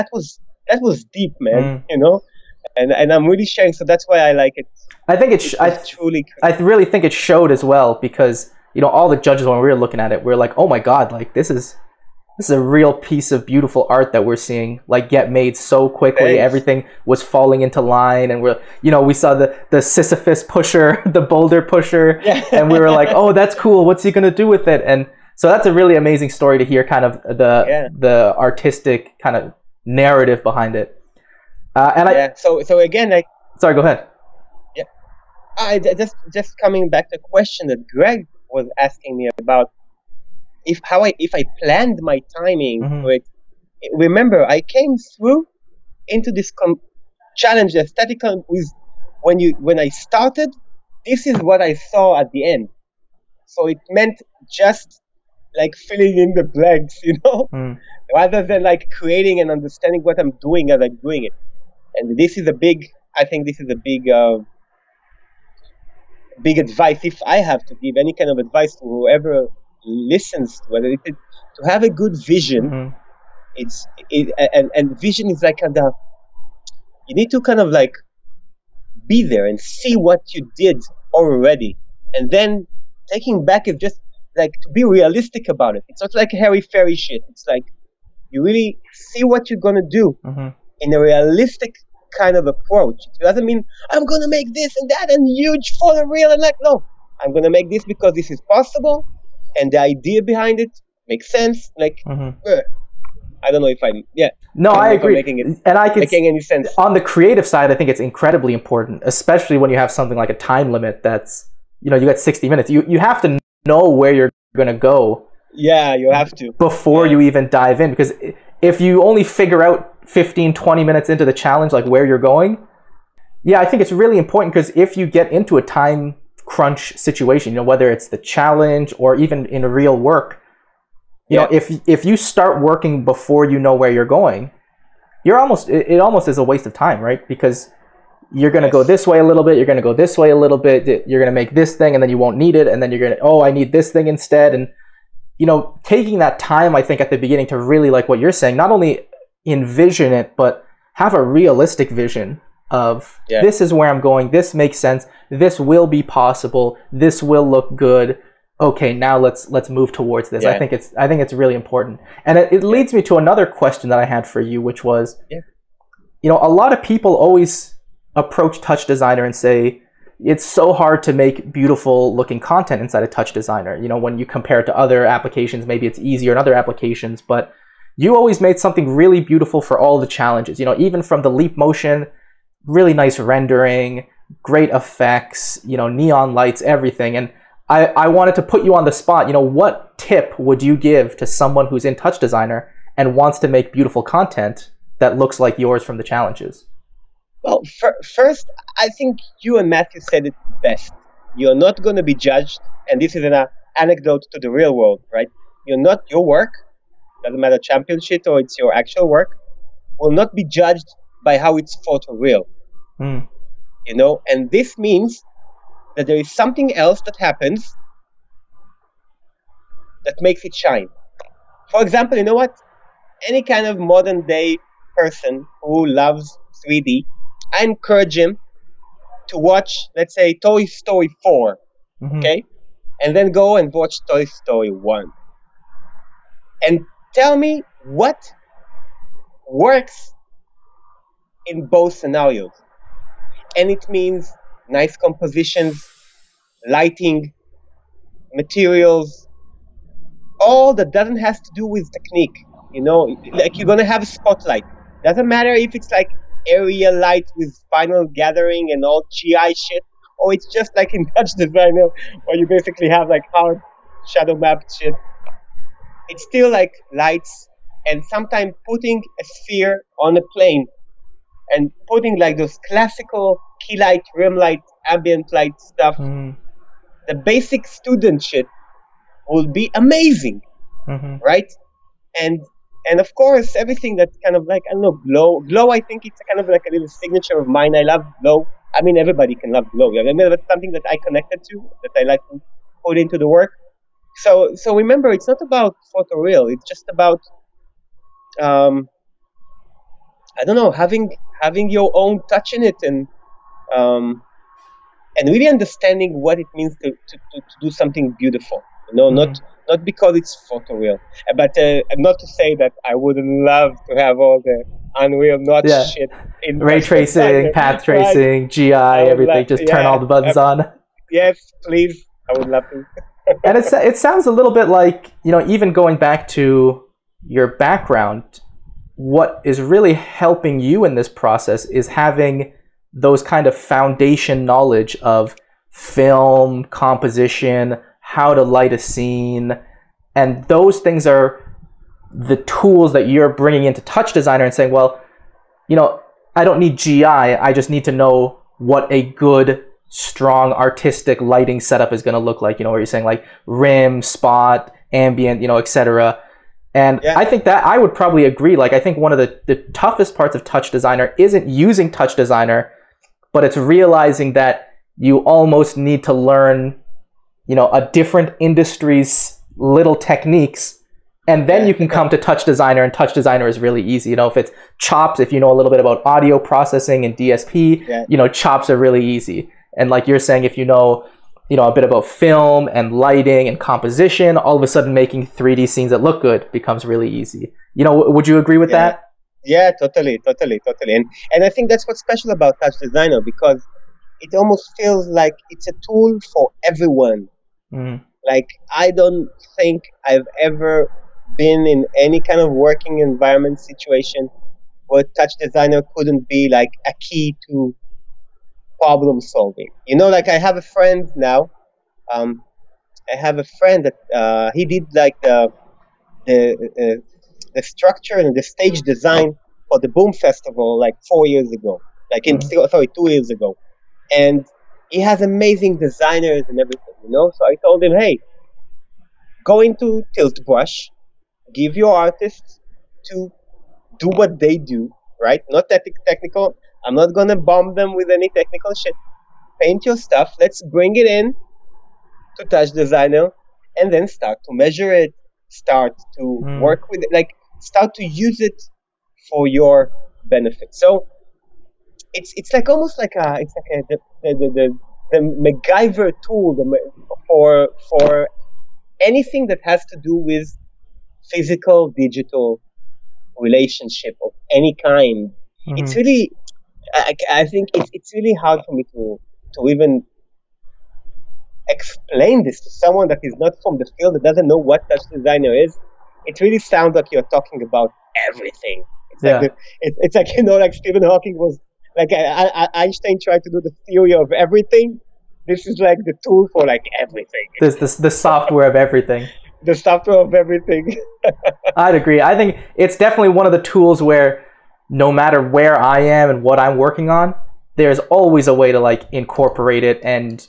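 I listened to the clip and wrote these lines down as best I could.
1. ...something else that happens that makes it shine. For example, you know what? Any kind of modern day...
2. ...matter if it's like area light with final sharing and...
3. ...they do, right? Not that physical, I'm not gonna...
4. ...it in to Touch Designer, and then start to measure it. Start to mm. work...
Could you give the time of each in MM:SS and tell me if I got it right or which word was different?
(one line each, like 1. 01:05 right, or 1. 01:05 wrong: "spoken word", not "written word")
1. 03:36 right
2. 04:15 wrong: "gathering", not "sharing"
3. 07:14 wrong: "technical", not "physical"
4. 07:20 right.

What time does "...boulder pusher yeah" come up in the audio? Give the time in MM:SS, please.
00:21.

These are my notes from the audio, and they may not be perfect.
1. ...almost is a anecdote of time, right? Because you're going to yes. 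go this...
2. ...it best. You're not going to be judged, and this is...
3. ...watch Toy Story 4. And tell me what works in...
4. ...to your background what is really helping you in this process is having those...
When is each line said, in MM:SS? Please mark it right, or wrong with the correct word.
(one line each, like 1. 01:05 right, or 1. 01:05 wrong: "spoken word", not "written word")
1. 02:15 wrong: "waste", not "anecdote"
2. 03:20 right
3. 03:53 wrong: "1", not "4"
4. 05:26 right.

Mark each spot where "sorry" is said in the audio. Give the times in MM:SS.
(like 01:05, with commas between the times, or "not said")
00:33, 07:02.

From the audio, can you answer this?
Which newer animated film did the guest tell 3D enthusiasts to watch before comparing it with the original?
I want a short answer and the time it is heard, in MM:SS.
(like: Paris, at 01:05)
Toy Story 4, at 03:50.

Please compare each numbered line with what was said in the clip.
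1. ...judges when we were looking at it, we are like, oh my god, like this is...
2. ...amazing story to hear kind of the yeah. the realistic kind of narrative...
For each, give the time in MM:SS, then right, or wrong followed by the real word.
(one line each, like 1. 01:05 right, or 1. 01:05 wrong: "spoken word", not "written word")
1. 00:09 right
2. 00:25 wrong: "artistic", not "realistic".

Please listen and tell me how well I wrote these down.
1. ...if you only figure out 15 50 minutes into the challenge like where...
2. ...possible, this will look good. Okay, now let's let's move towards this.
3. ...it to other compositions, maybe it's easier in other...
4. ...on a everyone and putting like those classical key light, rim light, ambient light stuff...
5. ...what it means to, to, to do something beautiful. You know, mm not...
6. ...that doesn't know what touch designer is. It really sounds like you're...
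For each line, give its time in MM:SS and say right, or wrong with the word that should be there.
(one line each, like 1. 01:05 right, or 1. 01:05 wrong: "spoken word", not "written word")
1. 01:58 wrong: "20", not "50"
2. 02:36 right
3. 02:54 wrong: "applications", not "compositions"
4. 04:29 wrong: "plane", not "everyone"
5. 05:06 right
6. 07:54 right.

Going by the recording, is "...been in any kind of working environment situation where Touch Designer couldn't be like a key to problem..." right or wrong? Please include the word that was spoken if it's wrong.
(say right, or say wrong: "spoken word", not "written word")
right.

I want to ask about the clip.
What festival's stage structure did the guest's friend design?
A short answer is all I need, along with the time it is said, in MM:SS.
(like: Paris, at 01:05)
Boom Festival, at 06:59.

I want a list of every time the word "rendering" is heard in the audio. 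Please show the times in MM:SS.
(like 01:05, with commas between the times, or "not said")
03:03.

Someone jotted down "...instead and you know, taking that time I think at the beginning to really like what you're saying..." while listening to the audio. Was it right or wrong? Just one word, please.
right.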